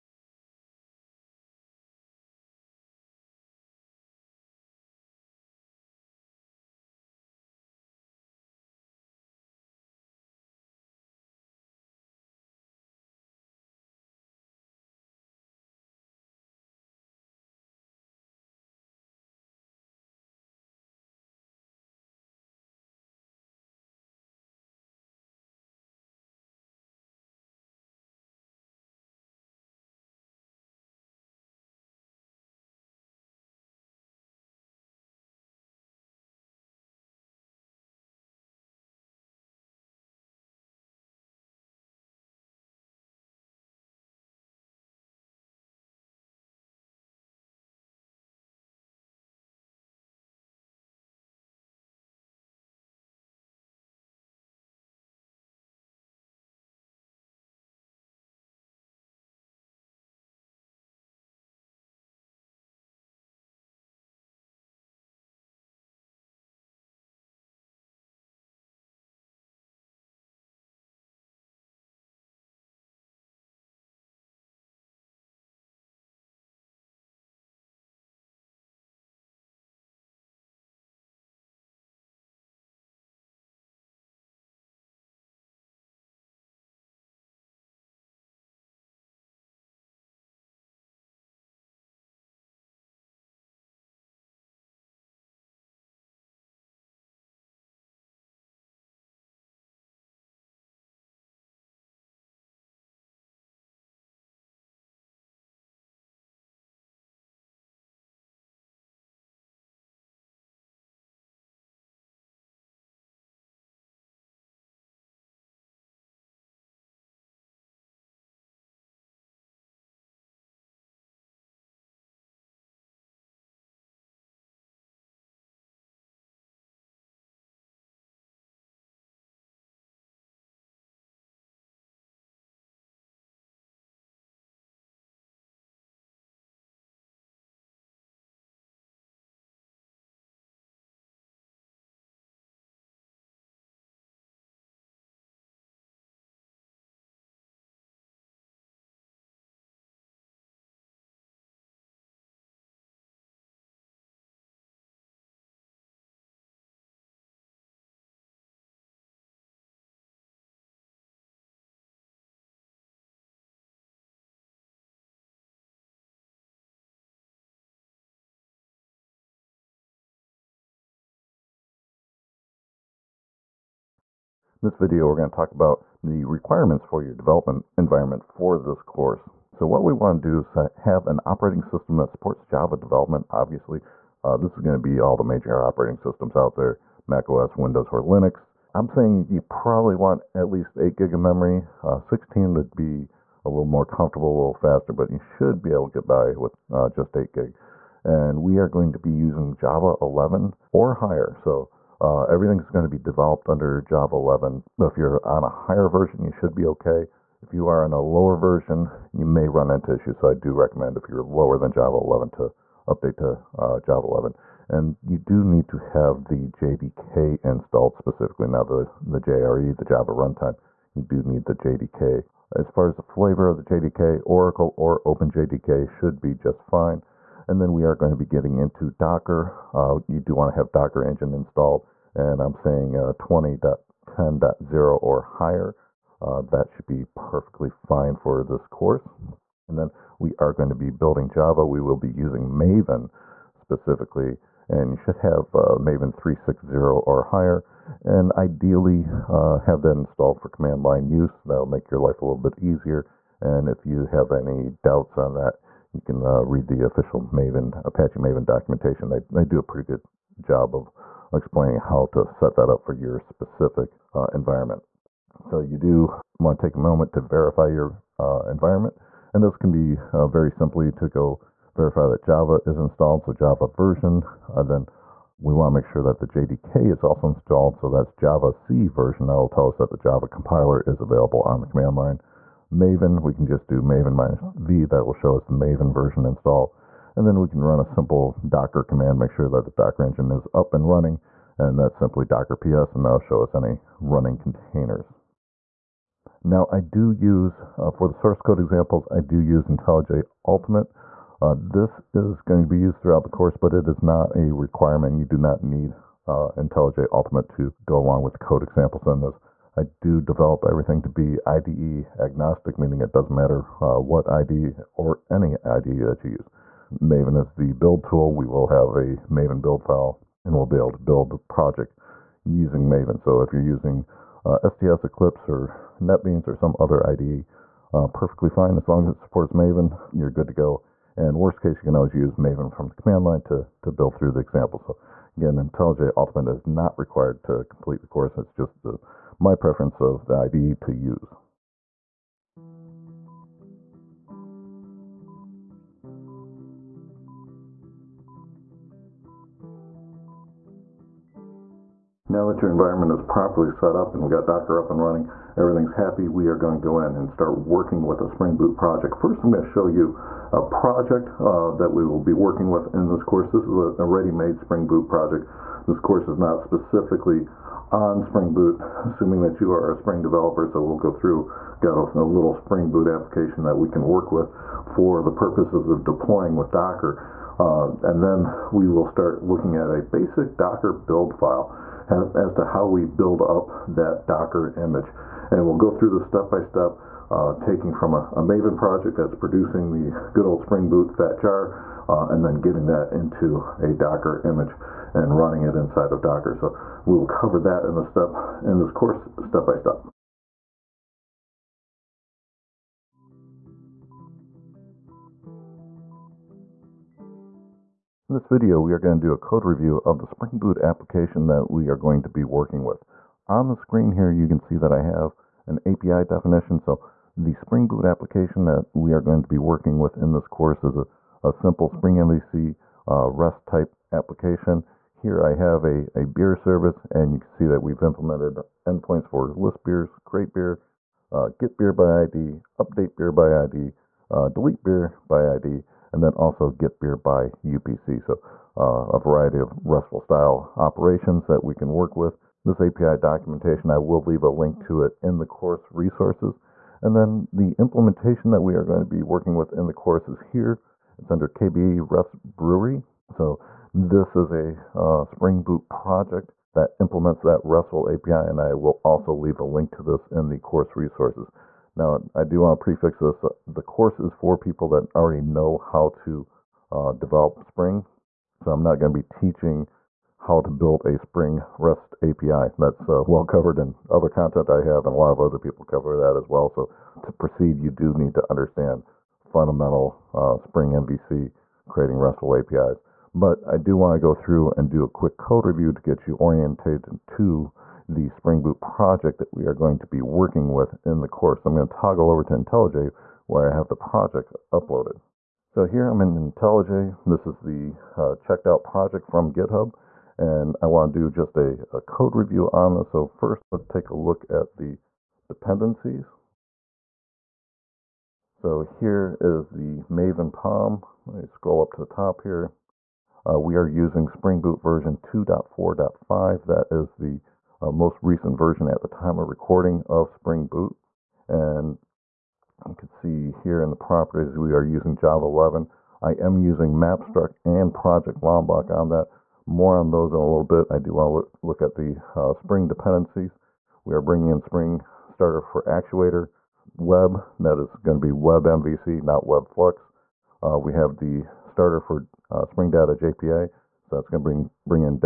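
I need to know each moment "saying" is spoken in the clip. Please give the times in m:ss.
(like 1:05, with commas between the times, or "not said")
3:08, 3:52.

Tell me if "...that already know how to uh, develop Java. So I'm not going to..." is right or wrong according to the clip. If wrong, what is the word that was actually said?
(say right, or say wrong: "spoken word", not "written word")
wrong: "Spring", not "Java".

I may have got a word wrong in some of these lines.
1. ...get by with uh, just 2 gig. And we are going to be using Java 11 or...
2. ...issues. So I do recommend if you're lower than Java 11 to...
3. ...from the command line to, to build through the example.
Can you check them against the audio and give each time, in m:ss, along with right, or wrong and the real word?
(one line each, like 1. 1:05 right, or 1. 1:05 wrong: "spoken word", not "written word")
1. 3:15 wrong: "8", not "2"
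2. 3:29 right
3. 5:32 right.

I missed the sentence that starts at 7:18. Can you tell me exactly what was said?
So uh, a variety of RESTful style operations that we can work with.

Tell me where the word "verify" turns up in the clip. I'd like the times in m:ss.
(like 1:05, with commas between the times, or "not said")
4:27, 4:31.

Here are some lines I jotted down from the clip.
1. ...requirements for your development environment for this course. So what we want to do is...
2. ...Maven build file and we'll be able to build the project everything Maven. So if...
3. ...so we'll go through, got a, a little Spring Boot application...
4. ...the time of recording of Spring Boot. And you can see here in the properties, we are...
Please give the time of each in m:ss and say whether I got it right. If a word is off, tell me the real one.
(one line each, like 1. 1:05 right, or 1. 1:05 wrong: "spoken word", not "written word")
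1. 2:56 right
2. 5:19 wrong: "using", not "everything"
3. 6:10 right
4. 8:38 right.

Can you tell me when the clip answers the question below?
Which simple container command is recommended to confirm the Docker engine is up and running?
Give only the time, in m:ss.
4:52.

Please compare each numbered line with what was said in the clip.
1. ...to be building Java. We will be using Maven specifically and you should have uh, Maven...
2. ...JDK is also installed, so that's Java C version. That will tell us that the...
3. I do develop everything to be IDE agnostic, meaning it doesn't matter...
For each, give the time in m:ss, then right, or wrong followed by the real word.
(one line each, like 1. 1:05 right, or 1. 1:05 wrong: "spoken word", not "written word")
1. 4:00 right
2. 4:36 right
3. 5:09 right.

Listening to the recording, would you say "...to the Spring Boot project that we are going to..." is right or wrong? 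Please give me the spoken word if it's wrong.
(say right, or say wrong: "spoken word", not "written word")
right.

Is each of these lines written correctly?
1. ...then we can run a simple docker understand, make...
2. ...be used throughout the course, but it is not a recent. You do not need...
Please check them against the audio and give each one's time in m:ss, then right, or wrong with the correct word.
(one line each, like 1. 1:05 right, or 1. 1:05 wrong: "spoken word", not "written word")
1. 4:47 wrong: "command", not "understand"
2. 5:02 wrong: "requirement", not "recent".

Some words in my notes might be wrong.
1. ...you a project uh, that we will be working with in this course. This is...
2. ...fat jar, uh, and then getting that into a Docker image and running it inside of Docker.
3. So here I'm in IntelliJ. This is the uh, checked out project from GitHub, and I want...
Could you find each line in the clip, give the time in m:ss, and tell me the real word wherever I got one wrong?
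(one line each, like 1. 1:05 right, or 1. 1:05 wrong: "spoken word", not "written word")
1. 5:59 right
2. 6:31 right
3. 8:15 right.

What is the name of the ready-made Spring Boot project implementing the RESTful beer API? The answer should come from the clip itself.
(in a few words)
KBE REST Brewery.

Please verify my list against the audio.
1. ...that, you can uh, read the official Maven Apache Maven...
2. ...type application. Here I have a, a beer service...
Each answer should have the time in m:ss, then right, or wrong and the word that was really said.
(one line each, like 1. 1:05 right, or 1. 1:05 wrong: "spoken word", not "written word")
1. 4:15 right
2. 7:03 right.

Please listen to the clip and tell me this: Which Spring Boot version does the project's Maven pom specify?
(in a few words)
2.4.5.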